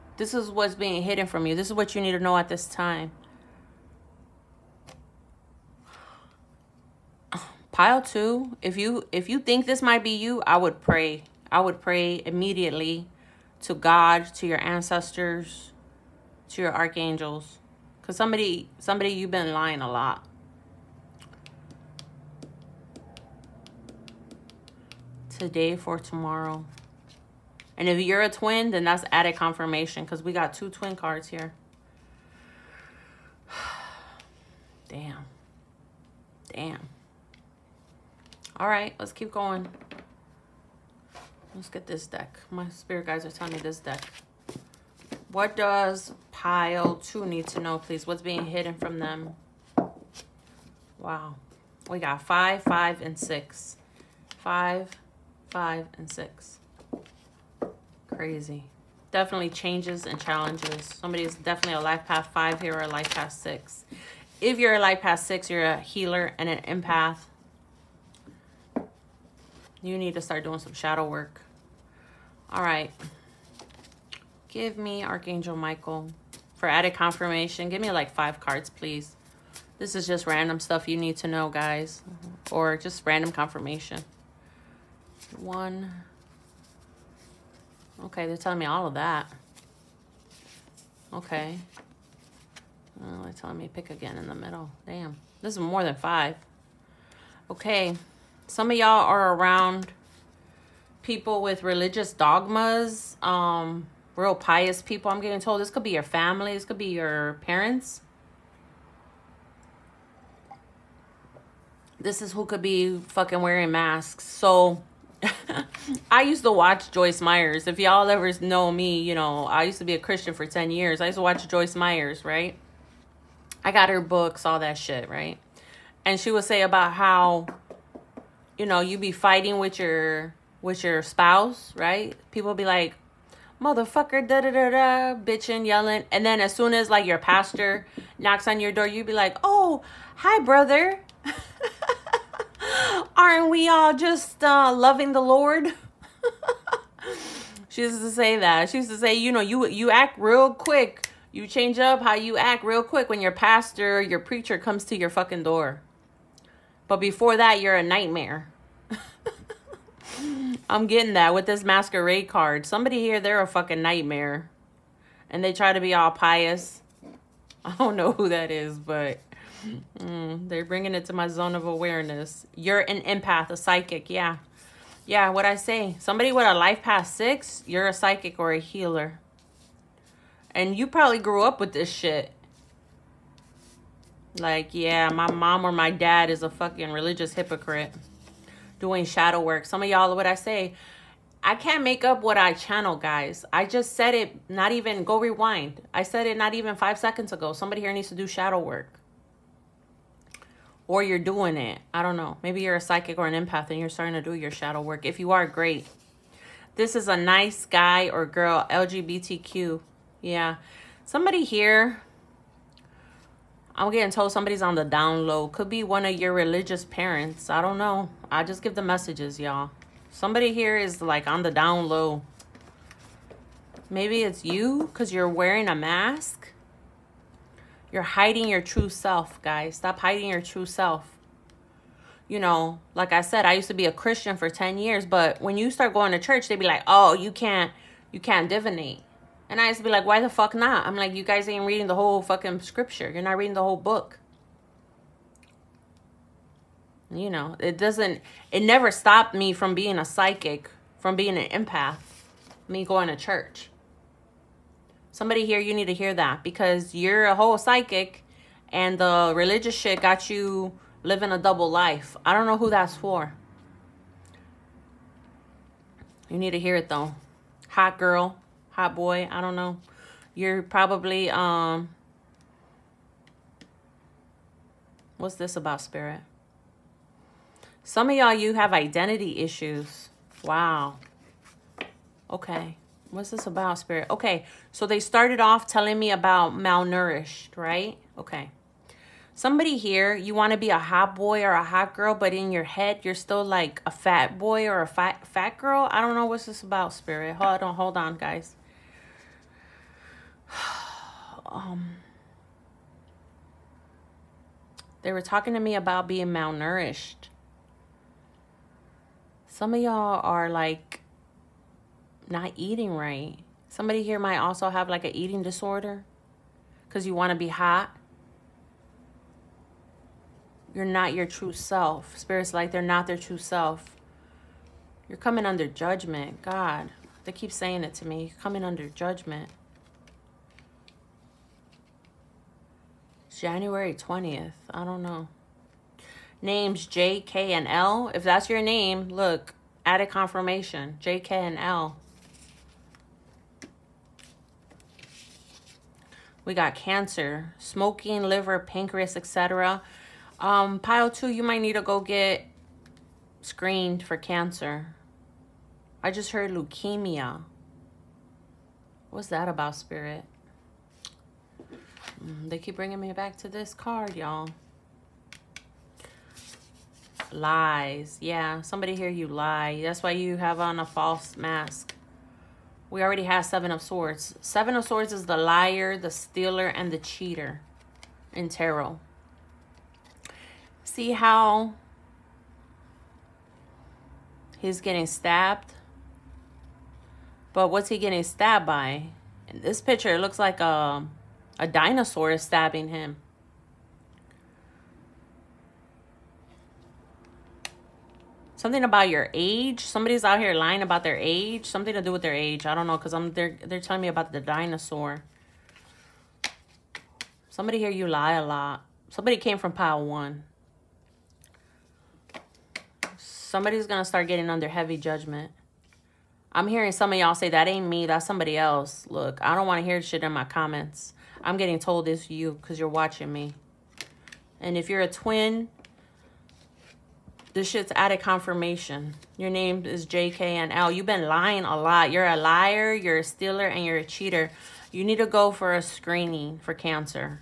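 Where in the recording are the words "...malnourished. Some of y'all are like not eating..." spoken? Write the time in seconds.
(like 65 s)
306 s.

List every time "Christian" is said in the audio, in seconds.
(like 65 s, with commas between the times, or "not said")
119 s, 233 s.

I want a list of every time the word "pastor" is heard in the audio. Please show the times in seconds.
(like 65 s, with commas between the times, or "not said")
137 s, 153 s.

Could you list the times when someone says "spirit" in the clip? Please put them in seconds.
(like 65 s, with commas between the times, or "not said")
42 s, 275 s, 283 s, 296 s, 322 s, 359 s.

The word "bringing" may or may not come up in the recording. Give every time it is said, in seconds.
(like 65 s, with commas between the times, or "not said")
170 s, 362 s.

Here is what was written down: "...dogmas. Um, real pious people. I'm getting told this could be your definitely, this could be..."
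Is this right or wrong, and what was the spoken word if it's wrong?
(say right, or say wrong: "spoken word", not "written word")
wrong: "family", not "definitely".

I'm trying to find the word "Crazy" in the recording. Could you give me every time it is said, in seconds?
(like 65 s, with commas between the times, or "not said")
58 s.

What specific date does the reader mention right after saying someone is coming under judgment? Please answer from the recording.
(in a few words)
January 20th.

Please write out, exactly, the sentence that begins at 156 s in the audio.
But before that, you're a nightmare.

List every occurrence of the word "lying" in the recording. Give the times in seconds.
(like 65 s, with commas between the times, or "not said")
19 s, 400 s, 431 s.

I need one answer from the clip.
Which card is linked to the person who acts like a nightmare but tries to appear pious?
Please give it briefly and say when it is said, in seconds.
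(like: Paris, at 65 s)
masquerade card, at 161 s.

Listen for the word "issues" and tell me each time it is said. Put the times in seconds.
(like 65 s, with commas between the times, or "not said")
279 s.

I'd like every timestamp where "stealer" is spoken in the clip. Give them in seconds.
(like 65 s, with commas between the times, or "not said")
376 s, 433 s.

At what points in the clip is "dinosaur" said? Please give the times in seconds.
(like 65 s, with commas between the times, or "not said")
391 s, 404 s.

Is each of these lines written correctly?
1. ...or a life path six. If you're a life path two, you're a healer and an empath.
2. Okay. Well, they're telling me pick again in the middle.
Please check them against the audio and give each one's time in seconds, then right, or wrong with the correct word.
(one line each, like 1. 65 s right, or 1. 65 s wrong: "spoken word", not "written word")
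1. 62 s wrong: "six", not "two"
2. 91 s right.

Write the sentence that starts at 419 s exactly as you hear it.
Look, I don't want to hear shit in my comments.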